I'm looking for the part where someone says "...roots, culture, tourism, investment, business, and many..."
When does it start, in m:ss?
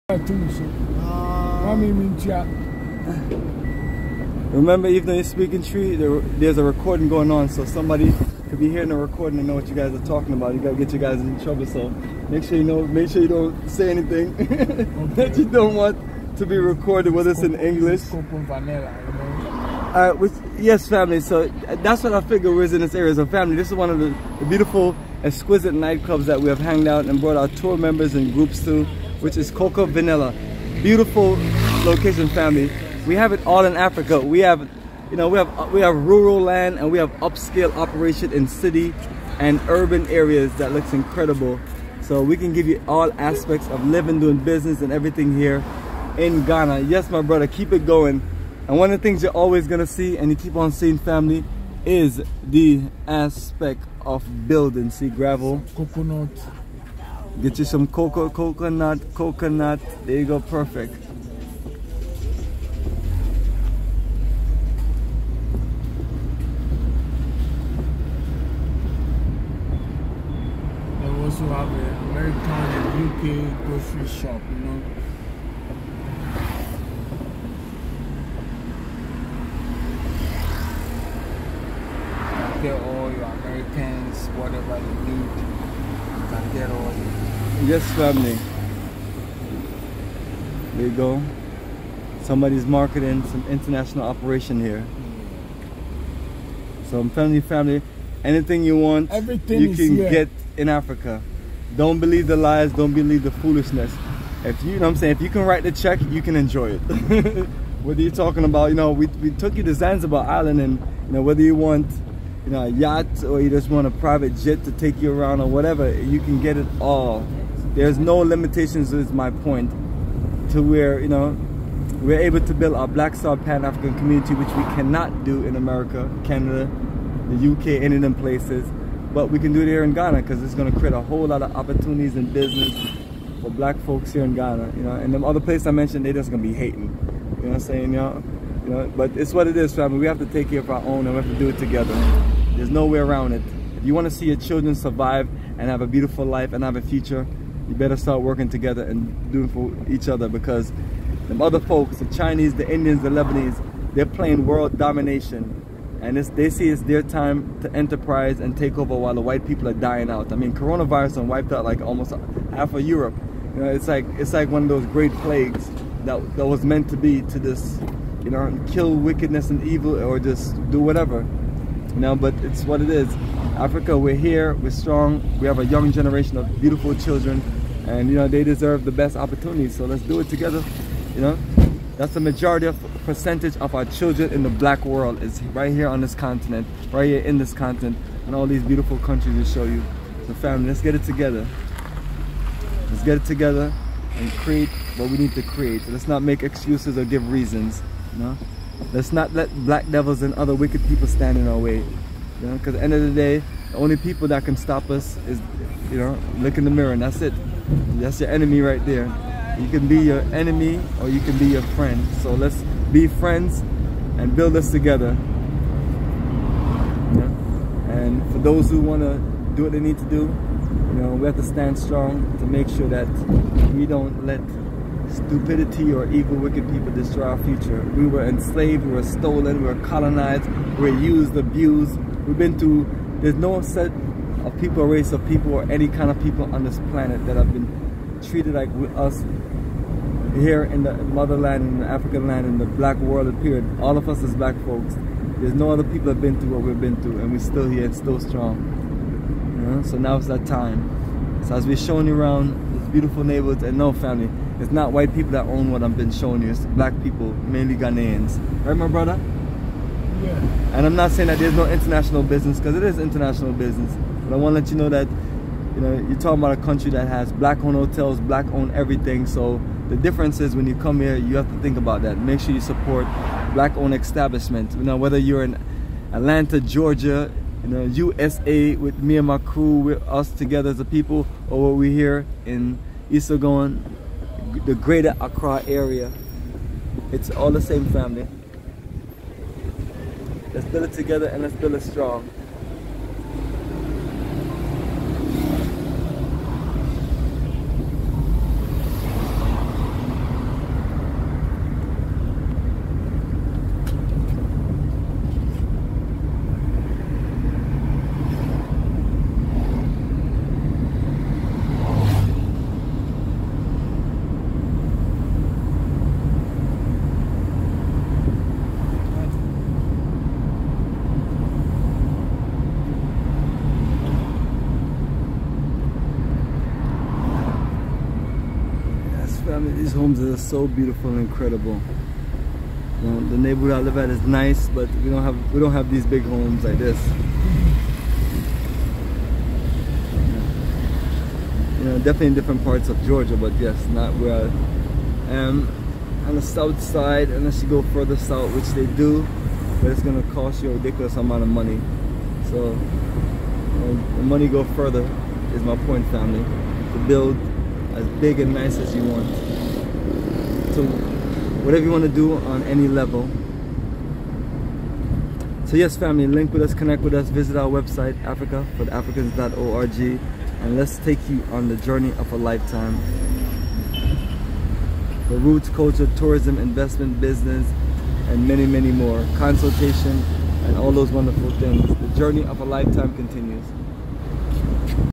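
6:15.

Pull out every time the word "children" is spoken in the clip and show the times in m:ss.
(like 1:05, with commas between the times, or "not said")
2:24, 2:56, 3:03.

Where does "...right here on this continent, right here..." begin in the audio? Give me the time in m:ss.
3:05.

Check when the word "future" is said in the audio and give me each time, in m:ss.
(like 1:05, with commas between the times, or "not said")
2:26, 3:47.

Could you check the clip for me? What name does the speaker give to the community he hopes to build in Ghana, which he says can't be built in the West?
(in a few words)
Black Star Pan-African community.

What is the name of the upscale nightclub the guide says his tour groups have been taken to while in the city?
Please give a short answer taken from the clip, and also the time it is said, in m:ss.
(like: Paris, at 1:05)
Cocoa Vanilla, at 0:29.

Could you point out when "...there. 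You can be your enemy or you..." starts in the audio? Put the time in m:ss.
3:28.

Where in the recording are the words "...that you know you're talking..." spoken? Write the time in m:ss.
4:24.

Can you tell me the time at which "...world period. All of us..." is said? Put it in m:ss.
4:02.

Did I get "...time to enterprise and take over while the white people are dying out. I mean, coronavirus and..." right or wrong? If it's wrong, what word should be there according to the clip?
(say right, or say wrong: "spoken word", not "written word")
right.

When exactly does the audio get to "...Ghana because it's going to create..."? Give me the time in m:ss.
2:09.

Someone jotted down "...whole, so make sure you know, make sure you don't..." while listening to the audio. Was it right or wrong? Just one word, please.
wrong.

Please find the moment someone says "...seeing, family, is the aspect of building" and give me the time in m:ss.
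0:50.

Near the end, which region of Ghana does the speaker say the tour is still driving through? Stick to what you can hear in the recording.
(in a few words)
Greater Accra.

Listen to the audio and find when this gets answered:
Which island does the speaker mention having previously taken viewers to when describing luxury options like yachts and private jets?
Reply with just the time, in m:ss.
1:49.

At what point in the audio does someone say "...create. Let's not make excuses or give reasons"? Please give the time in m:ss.
3:15.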